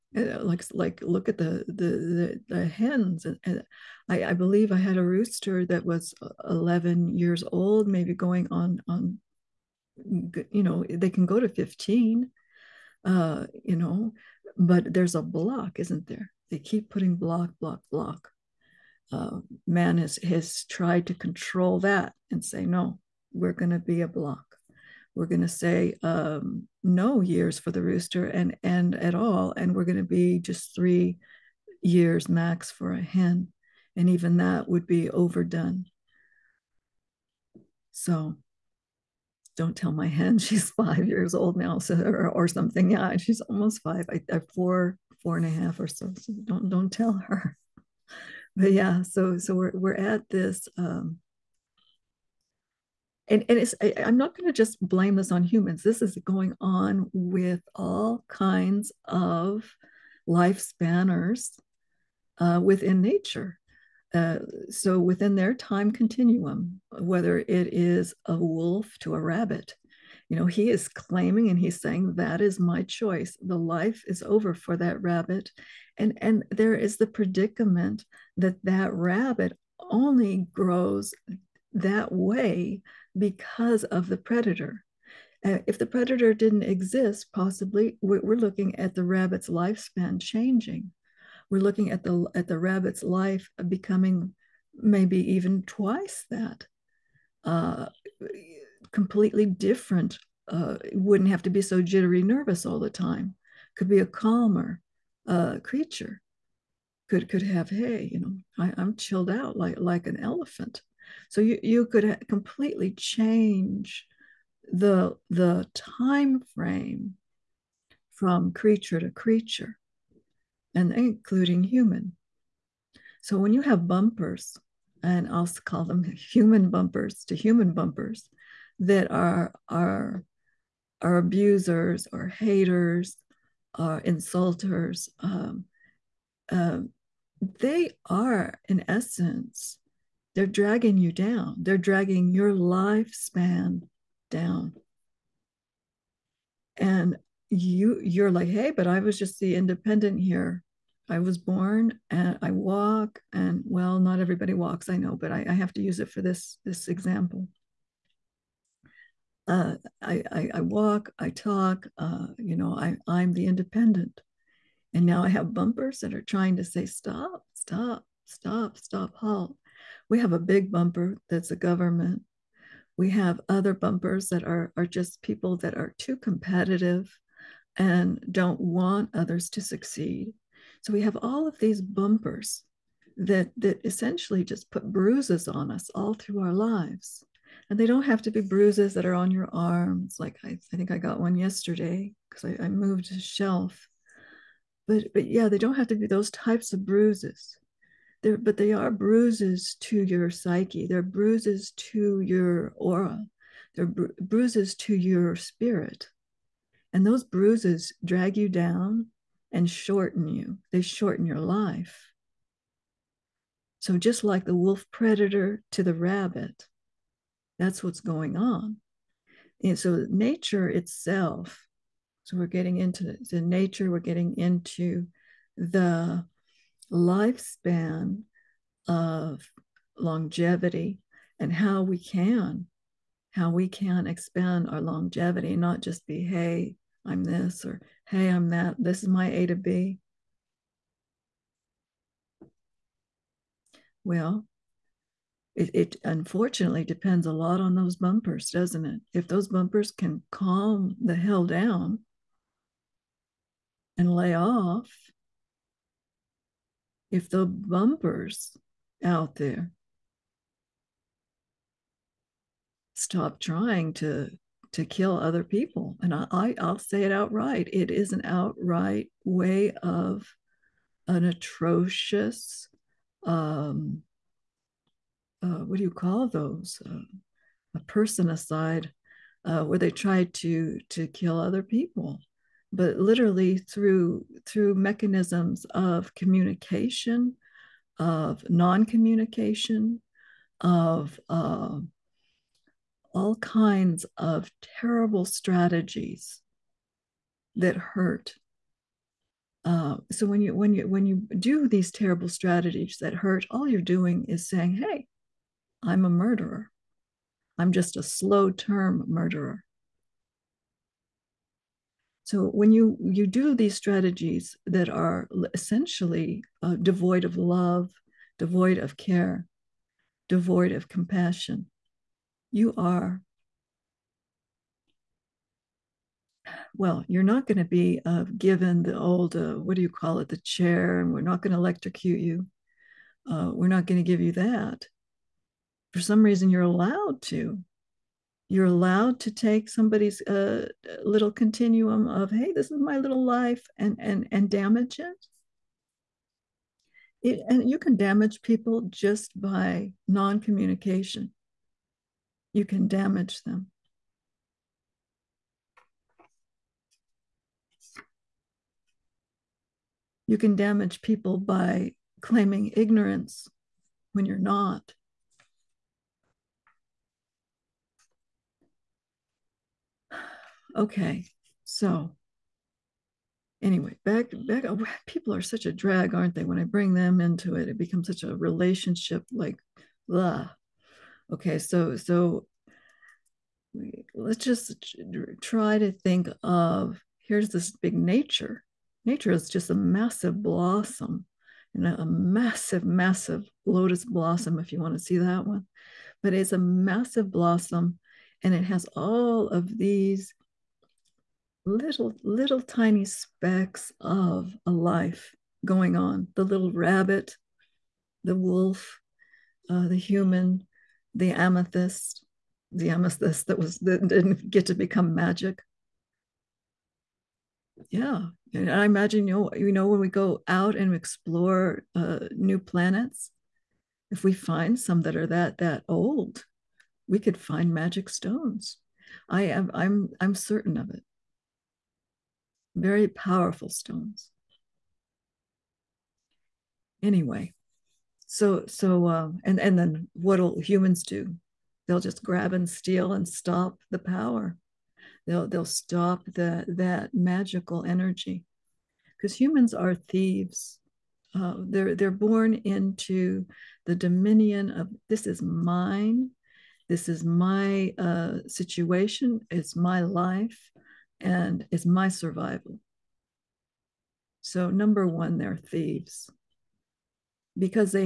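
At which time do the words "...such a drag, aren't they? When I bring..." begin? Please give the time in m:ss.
6:15.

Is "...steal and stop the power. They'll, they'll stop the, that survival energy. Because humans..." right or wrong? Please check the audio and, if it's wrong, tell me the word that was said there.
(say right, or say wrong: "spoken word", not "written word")
wrong: "magical", not "survival".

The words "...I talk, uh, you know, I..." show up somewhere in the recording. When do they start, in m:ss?
2:41.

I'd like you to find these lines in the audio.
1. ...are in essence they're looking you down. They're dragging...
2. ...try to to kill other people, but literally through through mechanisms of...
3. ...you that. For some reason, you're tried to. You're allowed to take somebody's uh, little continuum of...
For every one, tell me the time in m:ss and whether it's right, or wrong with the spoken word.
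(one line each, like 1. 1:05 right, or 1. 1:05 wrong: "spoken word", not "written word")
1. 2:18 wrong: "dragging", not "looking"
2. 4:39 right
3. 5:34 wrong: "allowed", not "tried".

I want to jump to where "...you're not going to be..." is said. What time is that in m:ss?
5:27.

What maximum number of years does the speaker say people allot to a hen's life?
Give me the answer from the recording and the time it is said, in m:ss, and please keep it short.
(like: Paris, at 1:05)
3 years, at 0:30.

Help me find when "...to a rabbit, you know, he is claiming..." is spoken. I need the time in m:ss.
1:08.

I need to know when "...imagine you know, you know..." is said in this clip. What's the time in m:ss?
6:58.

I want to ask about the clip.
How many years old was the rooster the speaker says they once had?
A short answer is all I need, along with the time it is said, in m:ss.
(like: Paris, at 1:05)
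11, at 0:06.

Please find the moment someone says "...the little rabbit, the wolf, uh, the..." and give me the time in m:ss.
6:46.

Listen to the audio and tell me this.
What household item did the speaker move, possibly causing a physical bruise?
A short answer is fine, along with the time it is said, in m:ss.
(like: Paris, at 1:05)
a shelf, at 3:13.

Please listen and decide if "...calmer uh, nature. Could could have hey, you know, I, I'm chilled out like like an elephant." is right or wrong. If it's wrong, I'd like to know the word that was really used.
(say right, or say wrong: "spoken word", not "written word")
wrong: "creature", not "nature".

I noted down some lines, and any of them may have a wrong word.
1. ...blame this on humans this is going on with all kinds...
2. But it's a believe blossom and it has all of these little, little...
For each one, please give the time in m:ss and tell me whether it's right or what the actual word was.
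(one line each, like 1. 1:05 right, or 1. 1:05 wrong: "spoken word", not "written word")
1. 0:54 right
2. 6:36 wrong: "massive", not "believe".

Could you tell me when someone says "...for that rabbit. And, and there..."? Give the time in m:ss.
1:14.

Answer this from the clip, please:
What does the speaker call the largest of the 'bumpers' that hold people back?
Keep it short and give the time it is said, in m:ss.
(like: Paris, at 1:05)
government, at 2:51.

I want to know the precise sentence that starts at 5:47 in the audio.
it and you can damage people just by non-communication you can damage them.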